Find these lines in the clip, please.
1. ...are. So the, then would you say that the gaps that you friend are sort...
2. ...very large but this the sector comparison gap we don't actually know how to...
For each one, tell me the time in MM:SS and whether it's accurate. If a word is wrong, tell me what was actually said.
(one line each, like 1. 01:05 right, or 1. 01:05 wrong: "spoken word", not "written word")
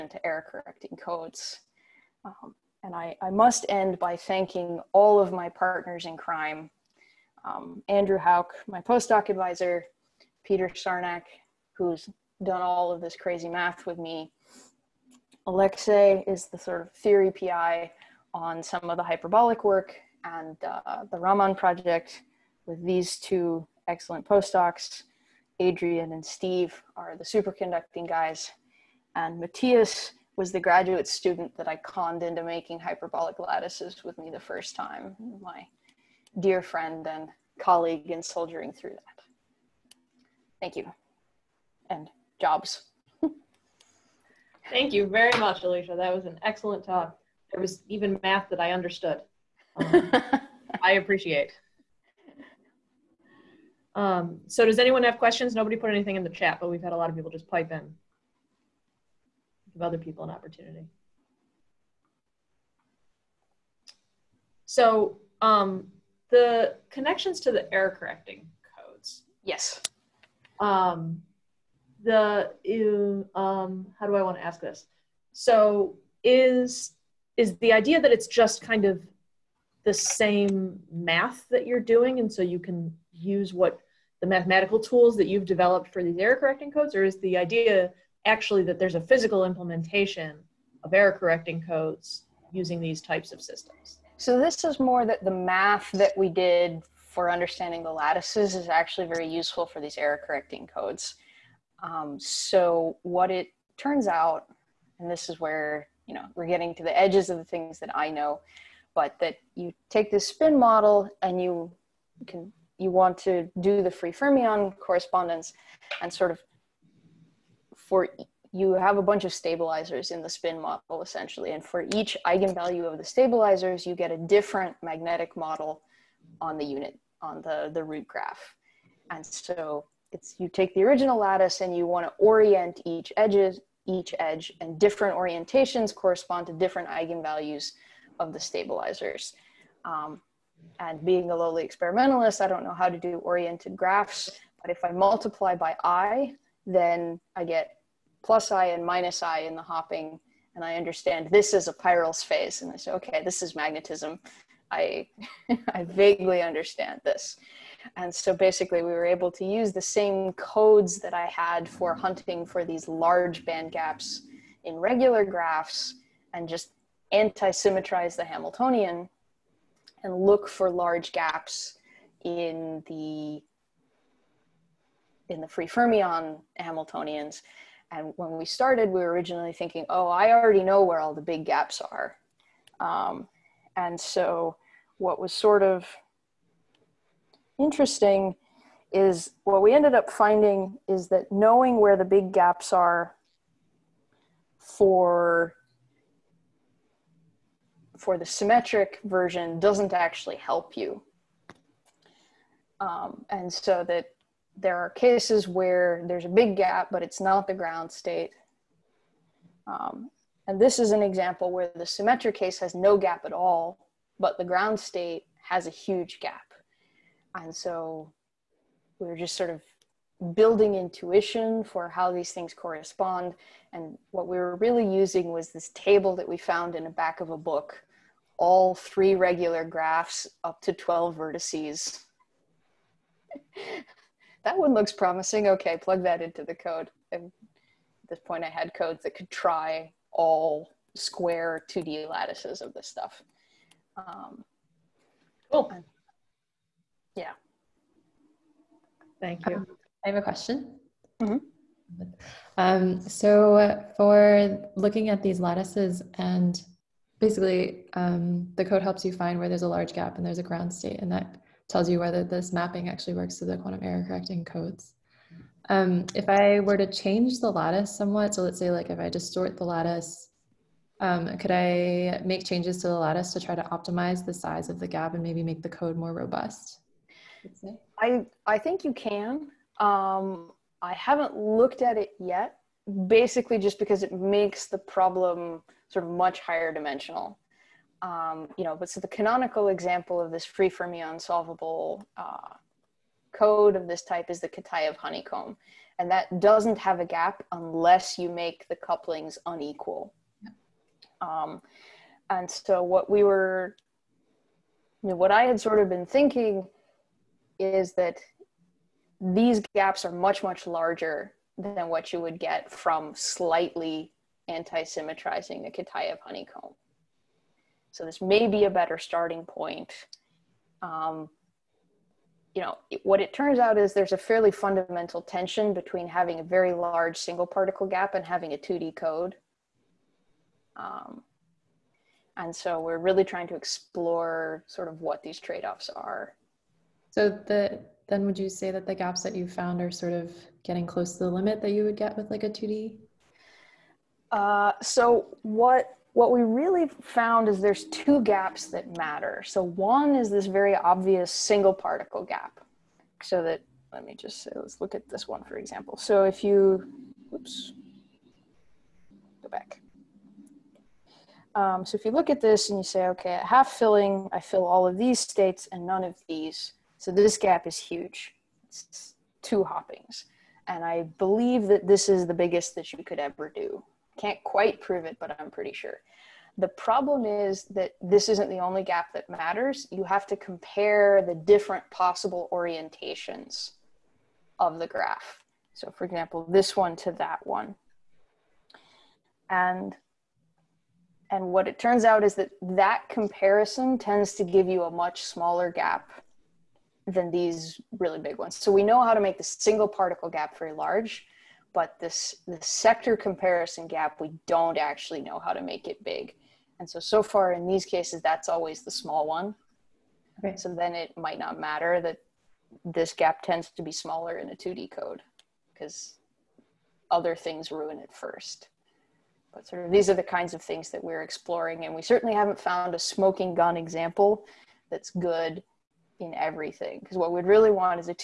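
1. 05:35 wrong: "found", not "friend"
2. 06:40 right.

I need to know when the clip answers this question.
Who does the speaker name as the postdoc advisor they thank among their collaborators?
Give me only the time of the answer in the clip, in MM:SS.
00:07.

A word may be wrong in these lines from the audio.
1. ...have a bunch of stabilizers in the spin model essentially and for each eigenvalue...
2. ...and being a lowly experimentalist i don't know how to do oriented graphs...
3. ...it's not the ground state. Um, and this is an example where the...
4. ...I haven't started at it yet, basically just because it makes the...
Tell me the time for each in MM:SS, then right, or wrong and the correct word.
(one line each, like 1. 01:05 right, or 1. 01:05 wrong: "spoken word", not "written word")
1. 01:58 right
2. 02:20 right
3. 03:27 right
4. 04:40 wrong: "looked", not "started".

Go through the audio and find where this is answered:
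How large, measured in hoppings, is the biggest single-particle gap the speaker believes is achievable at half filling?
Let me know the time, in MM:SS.
06:09.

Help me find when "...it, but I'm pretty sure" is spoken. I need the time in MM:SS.
06:15.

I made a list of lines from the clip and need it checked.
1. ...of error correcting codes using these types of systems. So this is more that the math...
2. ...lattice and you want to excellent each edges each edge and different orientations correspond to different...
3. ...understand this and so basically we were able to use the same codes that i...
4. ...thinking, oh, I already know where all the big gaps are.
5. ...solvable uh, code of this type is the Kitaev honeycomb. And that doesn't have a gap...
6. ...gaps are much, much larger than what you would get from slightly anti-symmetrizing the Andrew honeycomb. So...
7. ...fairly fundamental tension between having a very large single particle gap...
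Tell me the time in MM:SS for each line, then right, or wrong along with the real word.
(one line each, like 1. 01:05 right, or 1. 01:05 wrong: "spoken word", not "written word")
1. 01:30 right
2. 02:11 wrong: "orient", not "excellent"
3. 02:36 right
4. 02:59 right
5. 04:51 right
6. 05:09 wrong: "Kitaev", not "Andrew"
7. 05:24 right.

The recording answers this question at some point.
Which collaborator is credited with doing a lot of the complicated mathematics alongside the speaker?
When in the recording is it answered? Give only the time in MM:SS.
00:10.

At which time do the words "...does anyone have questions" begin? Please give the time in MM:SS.
00:54.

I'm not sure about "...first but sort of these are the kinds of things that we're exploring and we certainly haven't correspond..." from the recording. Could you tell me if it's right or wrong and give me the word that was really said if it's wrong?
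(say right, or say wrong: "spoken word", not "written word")
wrong: "found", not "correspond".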